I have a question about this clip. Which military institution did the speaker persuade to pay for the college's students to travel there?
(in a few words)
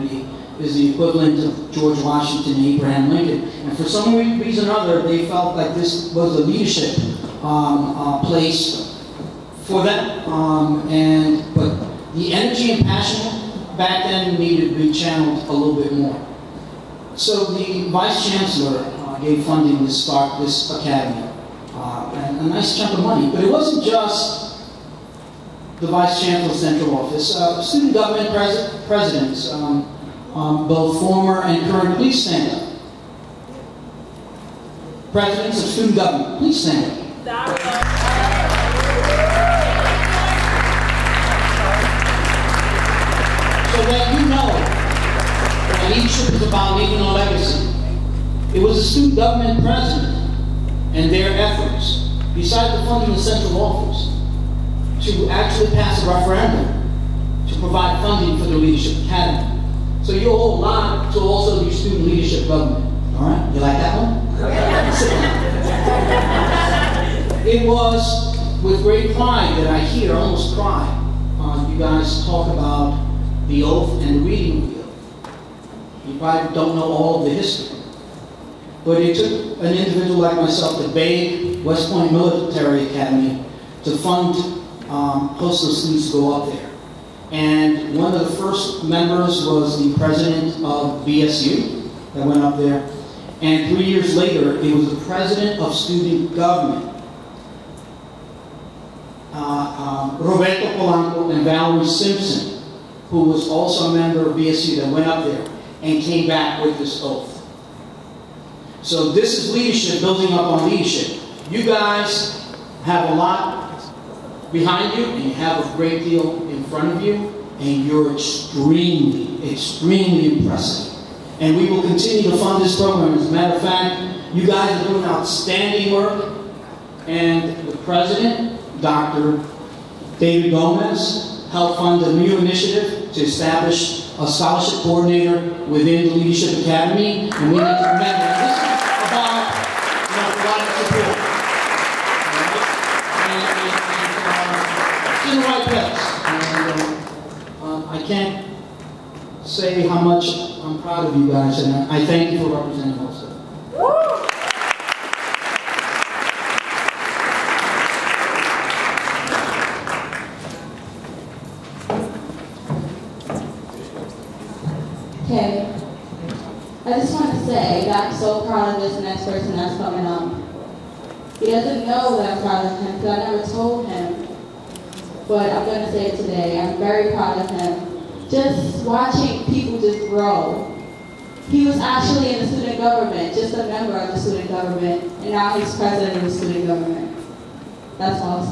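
West Point Military Academy.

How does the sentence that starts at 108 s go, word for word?
So this is leadership, building up on leadership.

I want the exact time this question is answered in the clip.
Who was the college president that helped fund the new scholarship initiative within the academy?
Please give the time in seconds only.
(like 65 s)
128 s.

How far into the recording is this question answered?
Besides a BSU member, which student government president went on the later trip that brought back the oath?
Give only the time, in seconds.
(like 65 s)
100 s.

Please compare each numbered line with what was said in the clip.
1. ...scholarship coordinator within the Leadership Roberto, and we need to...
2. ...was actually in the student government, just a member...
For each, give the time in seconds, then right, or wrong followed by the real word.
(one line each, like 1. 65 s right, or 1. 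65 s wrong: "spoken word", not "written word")
1. 134 s wrong: "Academy", not "Roberto"
2. 181 s right.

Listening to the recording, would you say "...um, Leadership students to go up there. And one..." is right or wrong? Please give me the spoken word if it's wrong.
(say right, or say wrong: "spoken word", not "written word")
wrong: "Hostos", not "Leadership".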